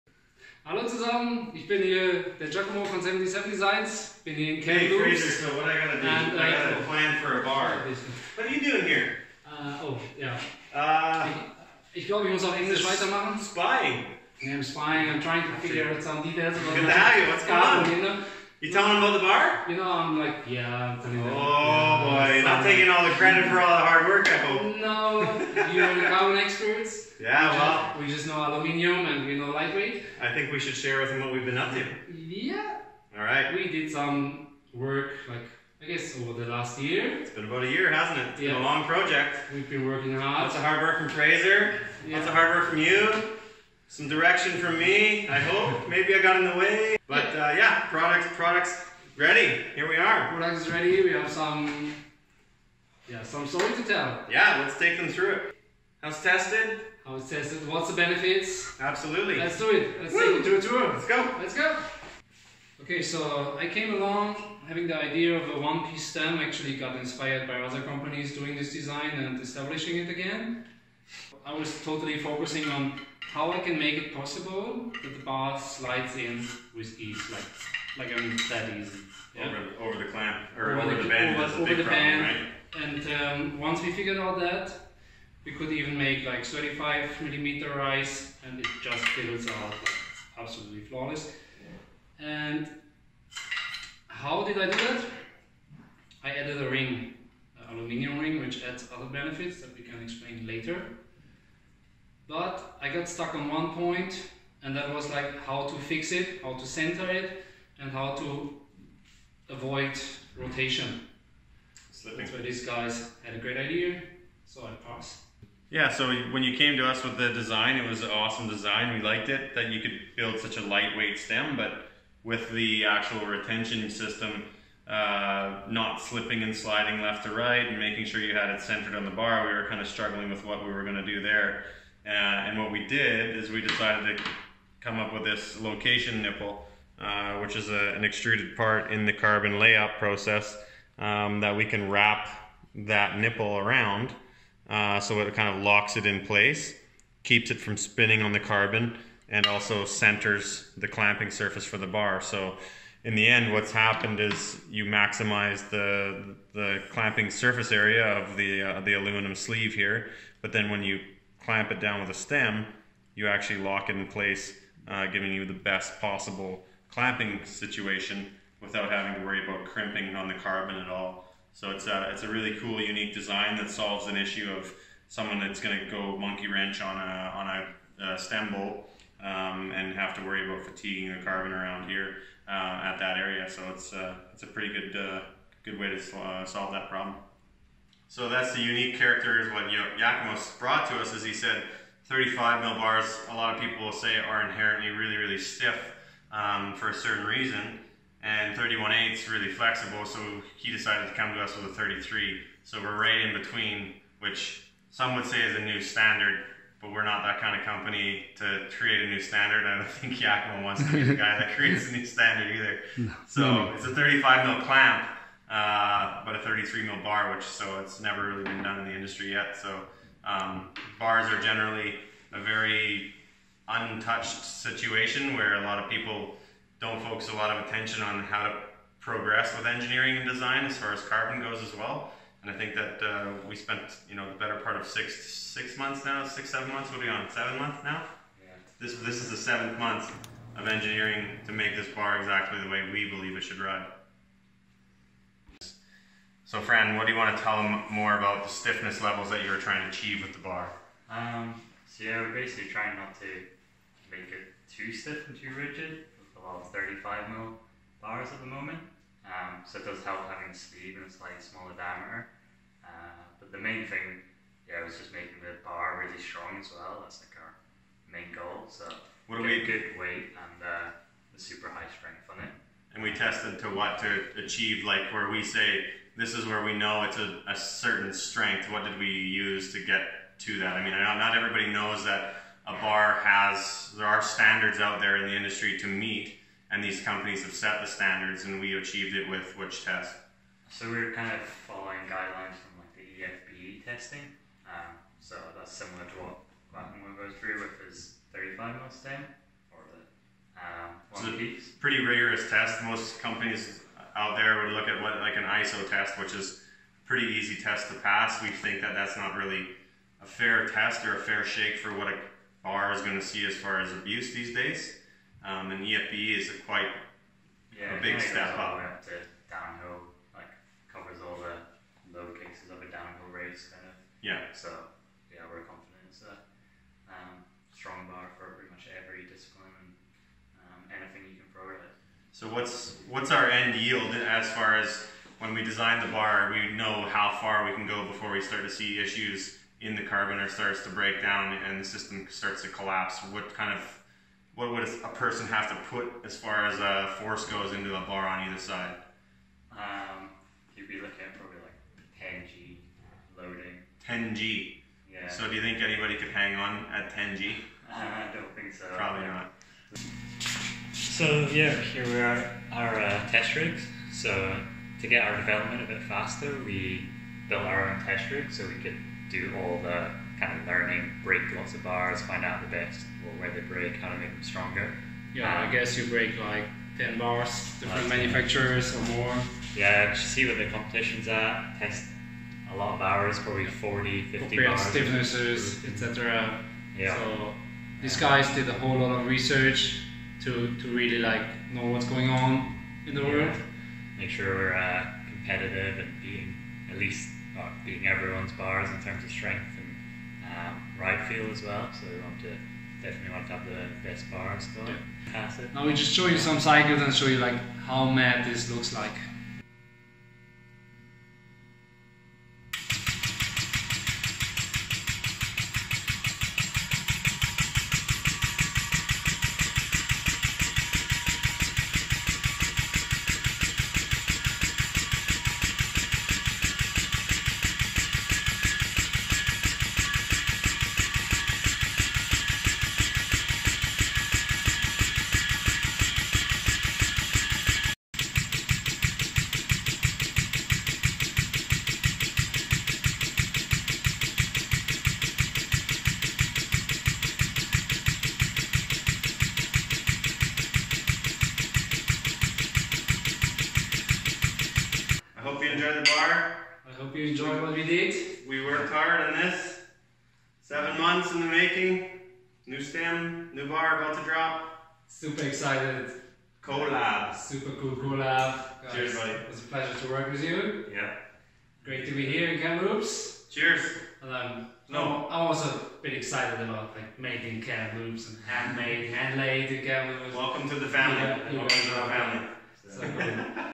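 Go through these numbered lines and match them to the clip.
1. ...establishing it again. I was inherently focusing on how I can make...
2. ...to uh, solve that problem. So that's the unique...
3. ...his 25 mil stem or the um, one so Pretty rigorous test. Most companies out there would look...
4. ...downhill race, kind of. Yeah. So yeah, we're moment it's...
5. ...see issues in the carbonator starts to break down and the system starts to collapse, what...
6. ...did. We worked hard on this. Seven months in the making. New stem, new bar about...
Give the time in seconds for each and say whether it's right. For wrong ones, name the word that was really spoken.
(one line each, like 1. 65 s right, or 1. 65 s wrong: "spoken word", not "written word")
1. 69 s wrong: "totally", not "inherently"
2. 185 s right
3. 297 s wrong: "35", not "25"
4. 322 s wrong: "confident", not "moment"
5. 338 s right
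6. 457 s right.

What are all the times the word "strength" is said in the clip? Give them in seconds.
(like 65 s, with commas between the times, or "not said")
271 s, 278 s, 399 s.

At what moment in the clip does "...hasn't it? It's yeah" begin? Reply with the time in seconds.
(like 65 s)
37 s.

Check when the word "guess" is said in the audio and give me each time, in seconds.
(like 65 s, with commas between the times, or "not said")
35 s, 375 s.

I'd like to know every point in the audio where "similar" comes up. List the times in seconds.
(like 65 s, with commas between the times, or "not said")
295 s.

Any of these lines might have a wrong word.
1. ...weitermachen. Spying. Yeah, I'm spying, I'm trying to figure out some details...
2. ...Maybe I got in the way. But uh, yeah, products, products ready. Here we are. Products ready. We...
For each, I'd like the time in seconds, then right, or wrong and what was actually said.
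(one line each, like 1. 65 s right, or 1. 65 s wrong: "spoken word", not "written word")
1. 12 s right
2. 45 s right.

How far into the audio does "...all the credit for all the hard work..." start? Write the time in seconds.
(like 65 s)
22 s.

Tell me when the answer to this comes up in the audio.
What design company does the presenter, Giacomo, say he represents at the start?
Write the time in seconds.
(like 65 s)
3 s.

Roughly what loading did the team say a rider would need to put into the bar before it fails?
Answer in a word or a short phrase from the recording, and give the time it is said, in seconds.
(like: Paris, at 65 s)
10G, at 352 s.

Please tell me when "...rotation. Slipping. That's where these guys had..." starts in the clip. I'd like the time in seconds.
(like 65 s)
110 s.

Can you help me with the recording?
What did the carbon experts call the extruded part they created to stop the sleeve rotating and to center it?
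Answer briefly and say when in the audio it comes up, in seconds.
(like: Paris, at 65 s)
Location nipple, at 135 s.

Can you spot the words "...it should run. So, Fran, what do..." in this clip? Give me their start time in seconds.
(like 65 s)
243 s.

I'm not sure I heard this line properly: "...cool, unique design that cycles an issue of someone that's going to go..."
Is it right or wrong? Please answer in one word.
wrong.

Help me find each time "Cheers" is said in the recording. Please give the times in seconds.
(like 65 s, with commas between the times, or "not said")
468 s, 473 s.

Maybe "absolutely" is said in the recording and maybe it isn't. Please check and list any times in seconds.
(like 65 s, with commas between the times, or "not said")
58 s, 90 s.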